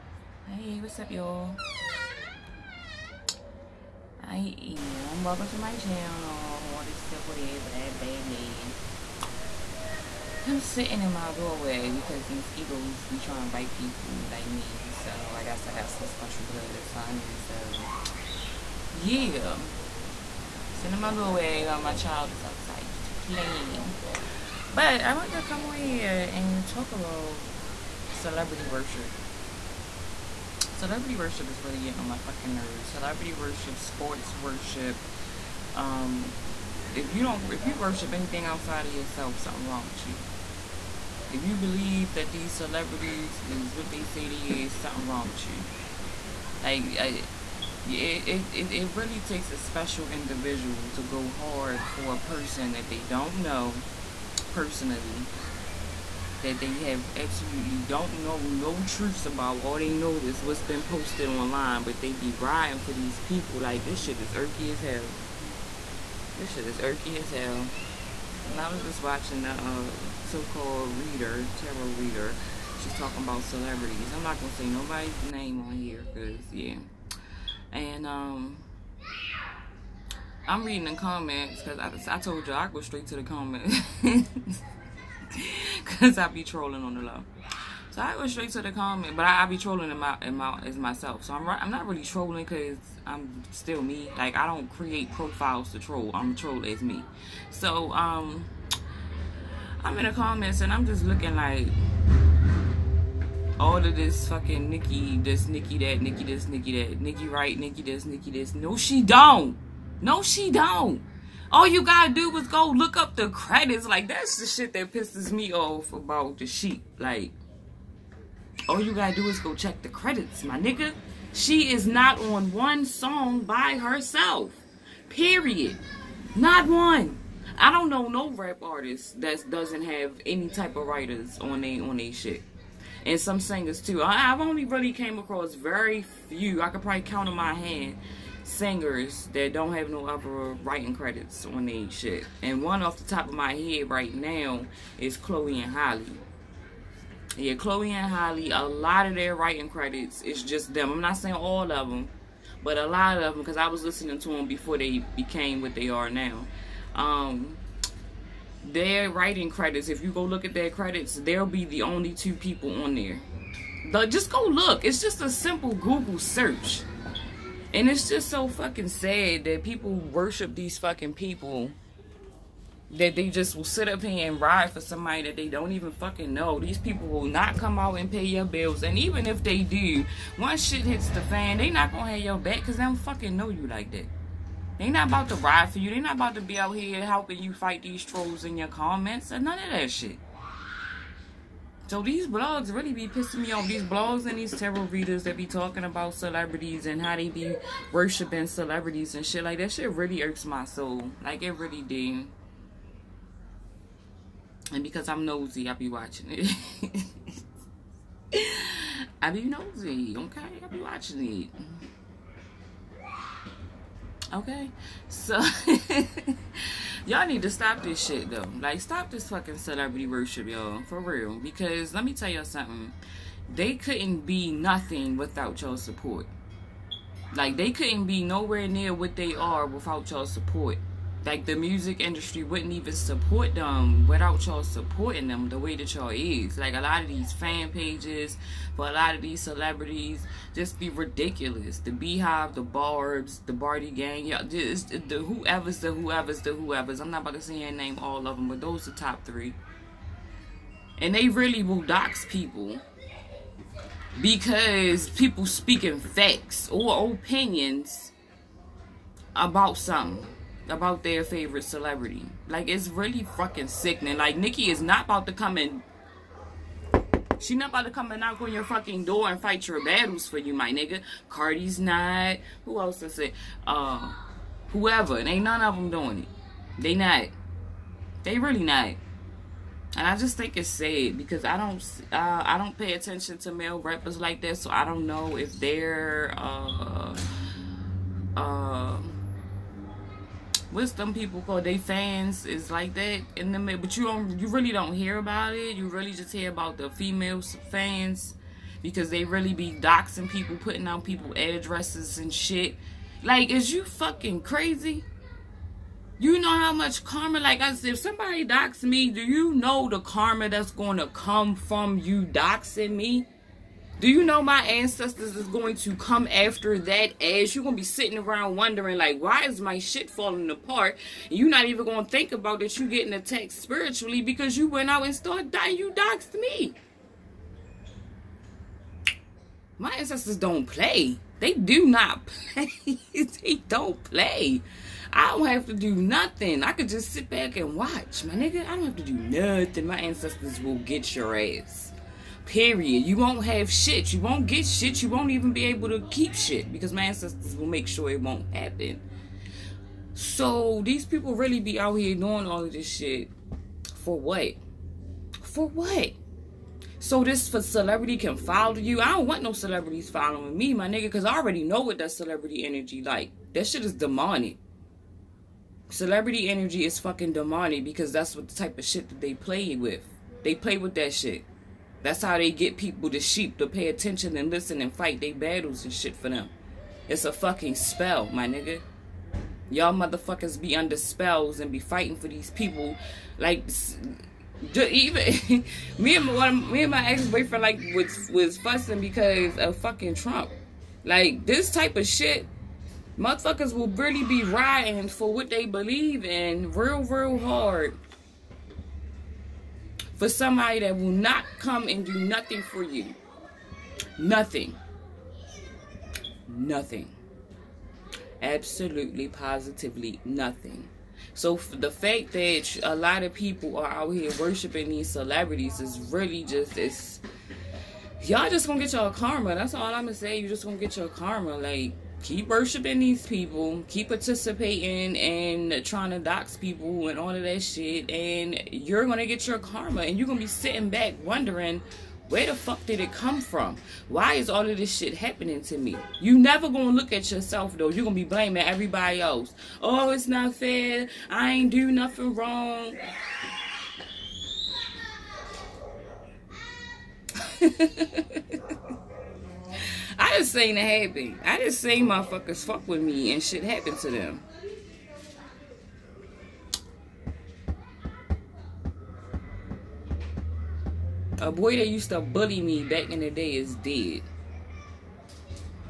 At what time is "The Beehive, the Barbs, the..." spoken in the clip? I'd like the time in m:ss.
4:01.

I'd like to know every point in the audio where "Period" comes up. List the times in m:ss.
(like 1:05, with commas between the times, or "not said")
2:05, 5:42.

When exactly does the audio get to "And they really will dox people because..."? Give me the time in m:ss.
4:10.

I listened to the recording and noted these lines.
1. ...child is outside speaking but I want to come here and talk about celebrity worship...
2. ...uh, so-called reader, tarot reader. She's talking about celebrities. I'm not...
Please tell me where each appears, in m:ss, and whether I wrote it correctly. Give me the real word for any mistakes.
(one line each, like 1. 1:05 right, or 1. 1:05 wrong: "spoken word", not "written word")
1. 0:21 wrong: "playing", not "speaking"
2. 1:09 right.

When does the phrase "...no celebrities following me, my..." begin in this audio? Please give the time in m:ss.
5:59.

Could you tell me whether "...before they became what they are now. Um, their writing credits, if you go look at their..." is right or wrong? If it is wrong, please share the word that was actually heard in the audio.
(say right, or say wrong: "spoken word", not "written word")
right.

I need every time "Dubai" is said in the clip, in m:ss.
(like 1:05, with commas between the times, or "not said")
not said.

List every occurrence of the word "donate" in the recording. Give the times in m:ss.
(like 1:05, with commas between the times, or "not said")
not said.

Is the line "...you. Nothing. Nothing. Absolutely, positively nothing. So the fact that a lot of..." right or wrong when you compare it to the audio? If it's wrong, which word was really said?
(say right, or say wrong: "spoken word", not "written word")
right.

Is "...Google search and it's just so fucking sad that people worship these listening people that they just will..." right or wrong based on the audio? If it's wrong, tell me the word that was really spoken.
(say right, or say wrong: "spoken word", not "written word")
wrong: "fucking", not "listening".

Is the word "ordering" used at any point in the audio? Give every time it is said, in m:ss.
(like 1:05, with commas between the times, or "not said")
not said.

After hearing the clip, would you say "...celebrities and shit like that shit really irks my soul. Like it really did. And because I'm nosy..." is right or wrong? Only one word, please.
right.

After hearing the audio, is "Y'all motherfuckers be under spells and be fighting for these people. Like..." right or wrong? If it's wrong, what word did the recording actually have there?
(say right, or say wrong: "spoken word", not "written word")
right.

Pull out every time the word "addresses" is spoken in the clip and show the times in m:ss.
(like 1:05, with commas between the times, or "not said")
5:01.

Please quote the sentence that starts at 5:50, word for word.
So these people really be out here doing all of this shit for what?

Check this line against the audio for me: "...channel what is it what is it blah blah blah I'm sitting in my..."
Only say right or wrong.
right.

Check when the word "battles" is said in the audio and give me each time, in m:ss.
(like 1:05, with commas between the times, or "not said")
4:29, 6:15.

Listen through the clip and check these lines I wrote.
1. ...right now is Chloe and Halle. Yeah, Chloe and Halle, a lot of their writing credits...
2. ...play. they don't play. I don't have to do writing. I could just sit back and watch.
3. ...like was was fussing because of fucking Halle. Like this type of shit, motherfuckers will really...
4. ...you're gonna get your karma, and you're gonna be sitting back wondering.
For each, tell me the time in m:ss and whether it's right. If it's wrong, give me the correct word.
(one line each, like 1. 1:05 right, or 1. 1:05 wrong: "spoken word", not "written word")
1. 2:23 right
2. 5:32 wrong: "nothing", not "writing"
3. 6:27 wrong: "Trump", not "Halle"
4. 7:08 right.